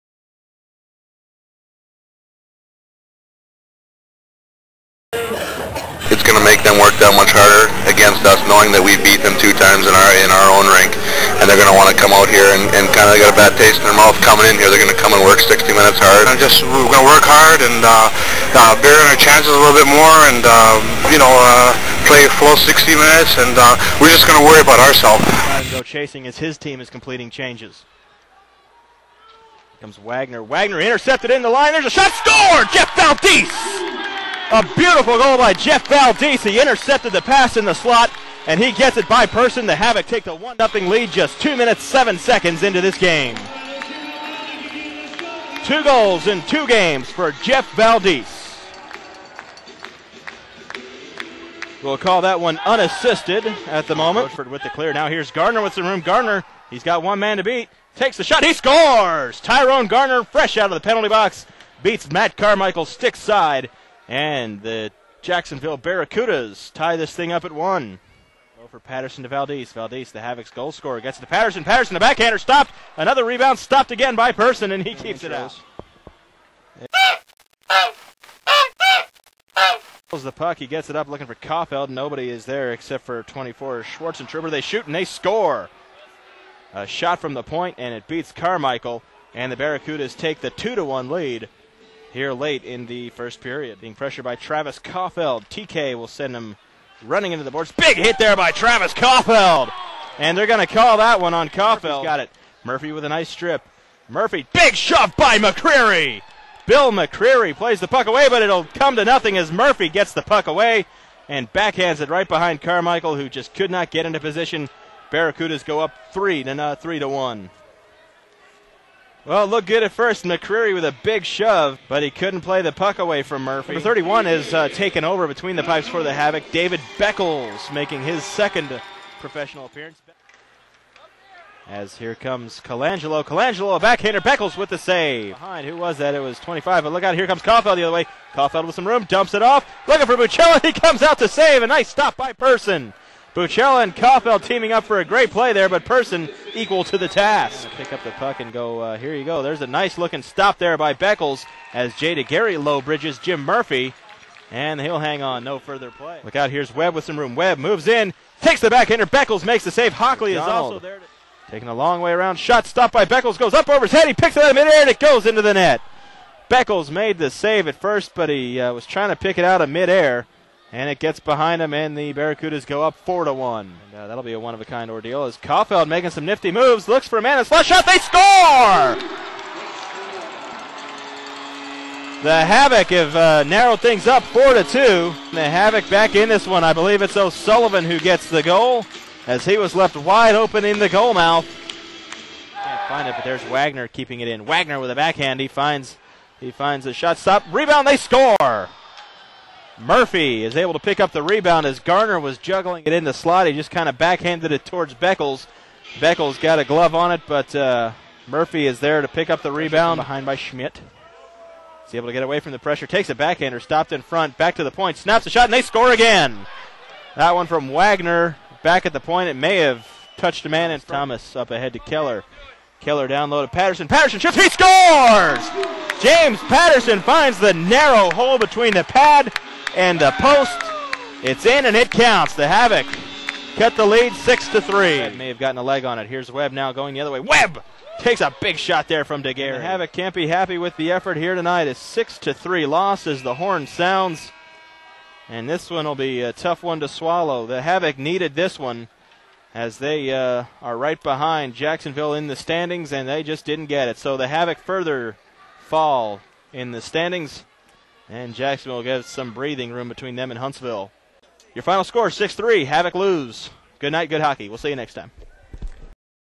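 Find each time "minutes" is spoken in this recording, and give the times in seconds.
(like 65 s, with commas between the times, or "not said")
15 s, 22 s, 41 s.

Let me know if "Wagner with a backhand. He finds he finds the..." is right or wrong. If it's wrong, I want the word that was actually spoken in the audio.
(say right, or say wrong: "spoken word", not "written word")
right.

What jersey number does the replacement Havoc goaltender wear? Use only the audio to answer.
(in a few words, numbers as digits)
31.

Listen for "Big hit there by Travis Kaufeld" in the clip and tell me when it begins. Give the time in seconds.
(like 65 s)
97 s.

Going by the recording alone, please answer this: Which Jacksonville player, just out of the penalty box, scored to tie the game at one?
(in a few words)
Tyrone Garner.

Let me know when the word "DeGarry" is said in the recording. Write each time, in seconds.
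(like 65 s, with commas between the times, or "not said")
239 s.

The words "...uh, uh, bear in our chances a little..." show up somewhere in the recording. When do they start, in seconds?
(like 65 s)
17 s.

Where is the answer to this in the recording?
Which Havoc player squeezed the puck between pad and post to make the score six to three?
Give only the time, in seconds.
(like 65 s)
226 s.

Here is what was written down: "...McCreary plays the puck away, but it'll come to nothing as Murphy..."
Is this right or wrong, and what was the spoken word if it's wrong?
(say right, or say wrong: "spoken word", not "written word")
right.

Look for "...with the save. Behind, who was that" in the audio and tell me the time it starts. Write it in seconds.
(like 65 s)
134 s.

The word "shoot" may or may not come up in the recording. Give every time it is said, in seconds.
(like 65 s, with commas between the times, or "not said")
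84 s, 224 s.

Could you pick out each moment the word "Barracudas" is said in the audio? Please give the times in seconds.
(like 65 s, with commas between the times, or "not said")
65 s, 89 s, 115 s, 172 s.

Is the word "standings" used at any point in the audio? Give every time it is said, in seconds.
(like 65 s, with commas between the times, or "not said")
252 s, 256 s.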